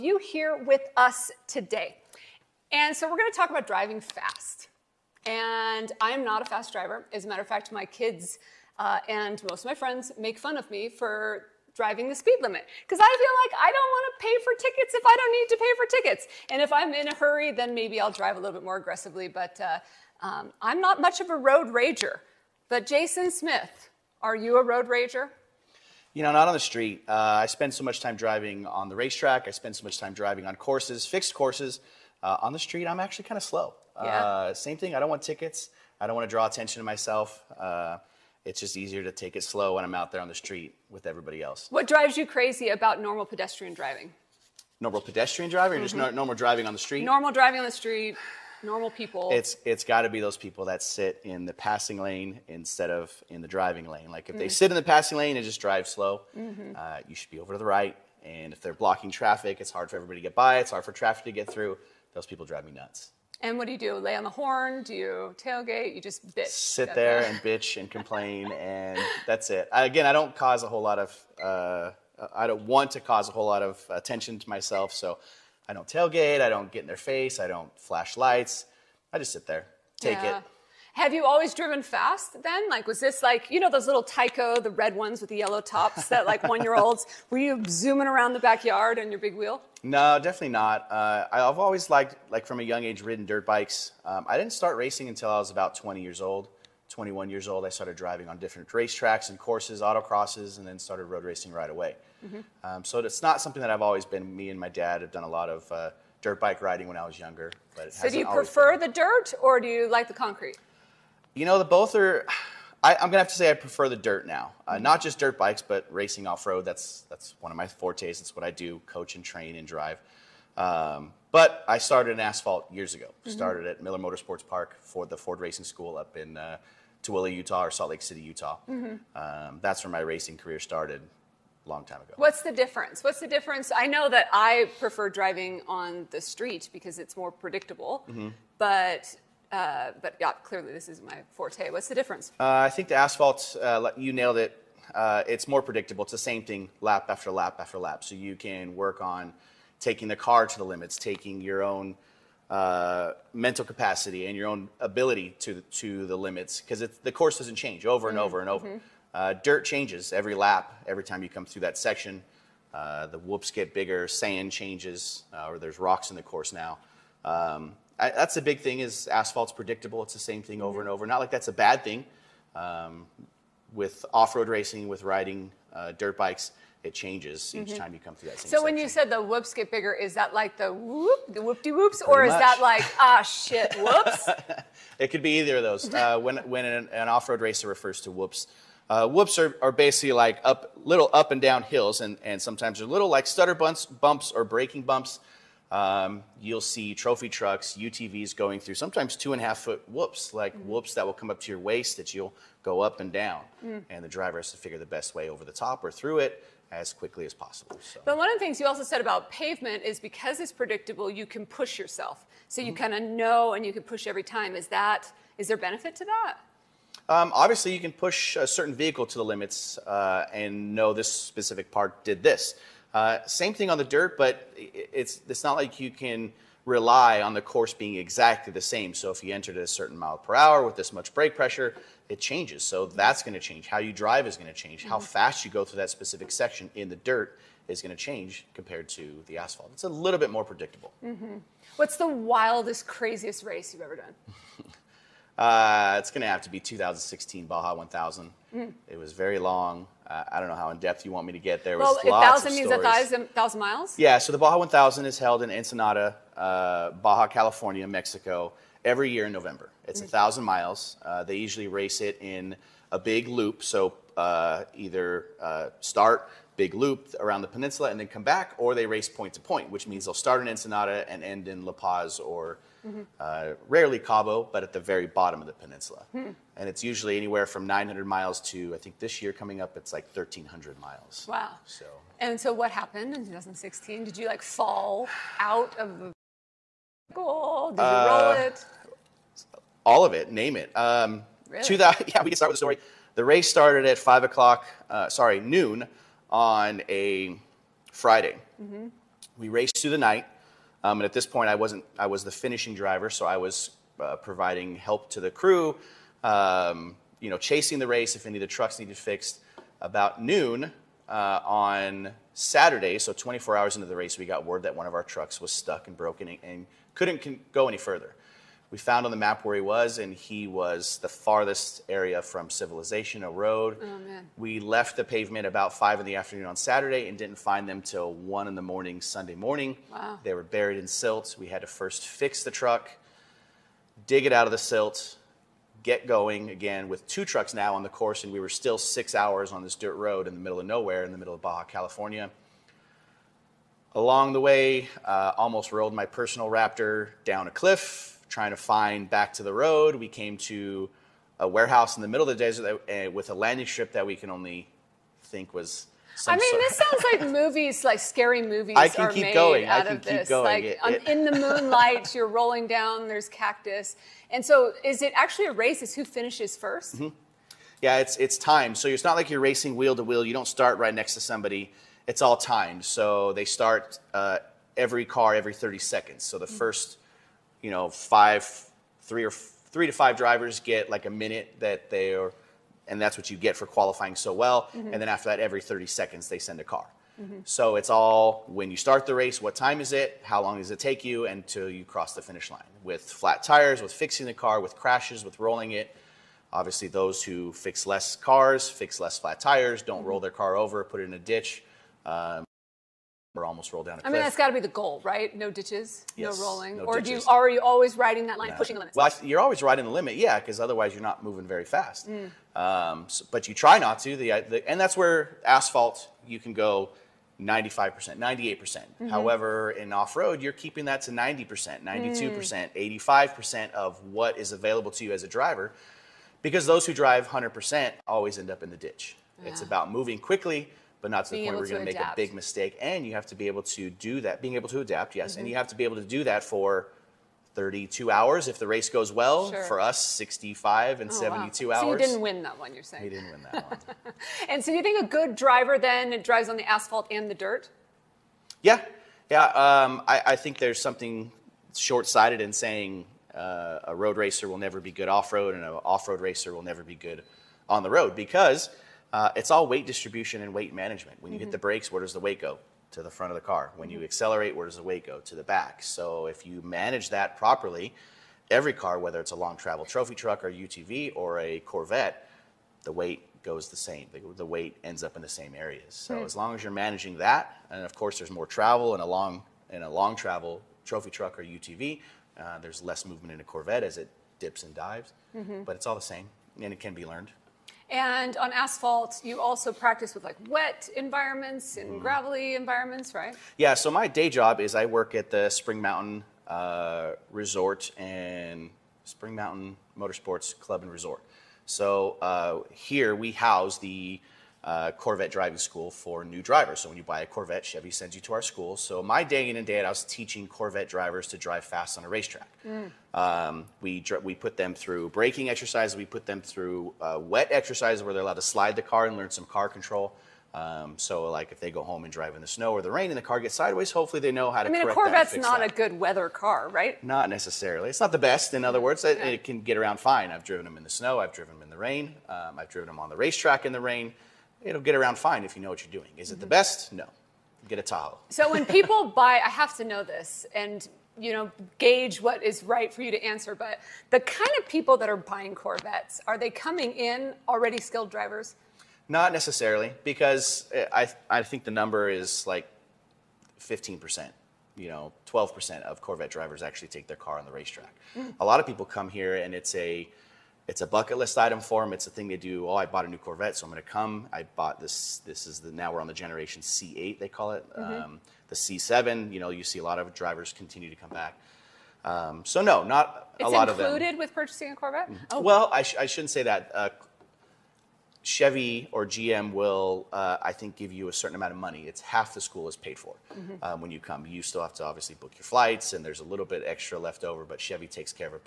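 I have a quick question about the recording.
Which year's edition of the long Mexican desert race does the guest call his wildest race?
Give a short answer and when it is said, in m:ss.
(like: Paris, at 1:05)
2016, at 4:06.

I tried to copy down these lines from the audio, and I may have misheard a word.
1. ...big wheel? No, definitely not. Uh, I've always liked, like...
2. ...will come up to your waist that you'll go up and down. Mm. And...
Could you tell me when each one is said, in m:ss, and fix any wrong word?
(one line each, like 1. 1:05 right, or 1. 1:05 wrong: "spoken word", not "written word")
1. 1:29 right
2. 3:21 right.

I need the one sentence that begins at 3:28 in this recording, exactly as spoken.
But one of the things you also said about pavement is because it's predictable, you can push yourself.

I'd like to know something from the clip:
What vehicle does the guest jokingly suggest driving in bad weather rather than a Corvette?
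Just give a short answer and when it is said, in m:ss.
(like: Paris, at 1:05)
Tahoe, at 8:57.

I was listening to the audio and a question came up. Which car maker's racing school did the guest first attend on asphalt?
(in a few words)
Ford.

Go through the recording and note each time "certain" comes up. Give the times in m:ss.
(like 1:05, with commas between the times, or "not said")
3:38, 3:49, 9:41.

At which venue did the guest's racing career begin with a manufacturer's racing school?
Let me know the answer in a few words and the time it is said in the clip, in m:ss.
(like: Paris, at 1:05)
Miller Motorsports Park, at 2:03.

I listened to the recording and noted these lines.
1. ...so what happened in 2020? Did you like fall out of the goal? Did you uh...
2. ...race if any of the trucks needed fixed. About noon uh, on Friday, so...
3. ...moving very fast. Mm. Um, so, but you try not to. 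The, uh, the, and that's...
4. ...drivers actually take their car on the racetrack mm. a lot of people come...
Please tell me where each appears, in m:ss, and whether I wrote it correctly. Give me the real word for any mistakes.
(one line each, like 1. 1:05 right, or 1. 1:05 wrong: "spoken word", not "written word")
1. 4:42 wrong: "2016", not "2020"
2. 5:07 wrong: "Saturday", not "Friday"
3. 6:51 right
4. 9:16 right.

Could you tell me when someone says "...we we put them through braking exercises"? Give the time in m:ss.
8:33.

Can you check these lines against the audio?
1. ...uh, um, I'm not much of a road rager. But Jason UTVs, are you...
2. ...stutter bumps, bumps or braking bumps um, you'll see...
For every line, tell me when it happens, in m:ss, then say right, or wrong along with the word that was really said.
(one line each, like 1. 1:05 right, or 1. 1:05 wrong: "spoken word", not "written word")
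1. 0:19 wrong: "Smith", not "UTVs"
2. 3:13 right.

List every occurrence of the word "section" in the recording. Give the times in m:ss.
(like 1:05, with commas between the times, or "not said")
2:41, 2:58, 3:56.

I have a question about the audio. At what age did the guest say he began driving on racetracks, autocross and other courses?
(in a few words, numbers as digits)
21.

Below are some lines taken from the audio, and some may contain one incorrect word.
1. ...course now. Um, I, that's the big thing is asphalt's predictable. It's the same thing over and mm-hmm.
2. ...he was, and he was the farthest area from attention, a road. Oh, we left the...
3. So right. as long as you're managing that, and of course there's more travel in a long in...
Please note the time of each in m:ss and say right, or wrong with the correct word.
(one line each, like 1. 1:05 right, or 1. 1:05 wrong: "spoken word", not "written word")
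1. 2:46 right
2. 5:19 wrong: "civilization", not "attention"
3. 7:55 right.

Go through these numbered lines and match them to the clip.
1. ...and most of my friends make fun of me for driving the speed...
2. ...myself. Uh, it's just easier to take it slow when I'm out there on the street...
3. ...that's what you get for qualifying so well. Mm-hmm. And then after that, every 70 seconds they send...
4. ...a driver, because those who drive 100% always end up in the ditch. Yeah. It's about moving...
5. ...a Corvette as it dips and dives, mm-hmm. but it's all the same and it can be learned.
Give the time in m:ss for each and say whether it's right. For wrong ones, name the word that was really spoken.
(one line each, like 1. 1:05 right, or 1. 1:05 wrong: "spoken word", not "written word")
1. 0:09 right
2. 0:36 right
3. 6:22 wrong: "30", not "70"
4. 7:05 right
5. 8:03 right.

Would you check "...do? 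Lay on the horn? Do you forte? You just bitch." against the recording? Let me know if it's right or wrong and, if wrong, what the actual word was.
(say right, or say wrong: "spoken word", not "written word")
wrong: "tailgate", not "forte".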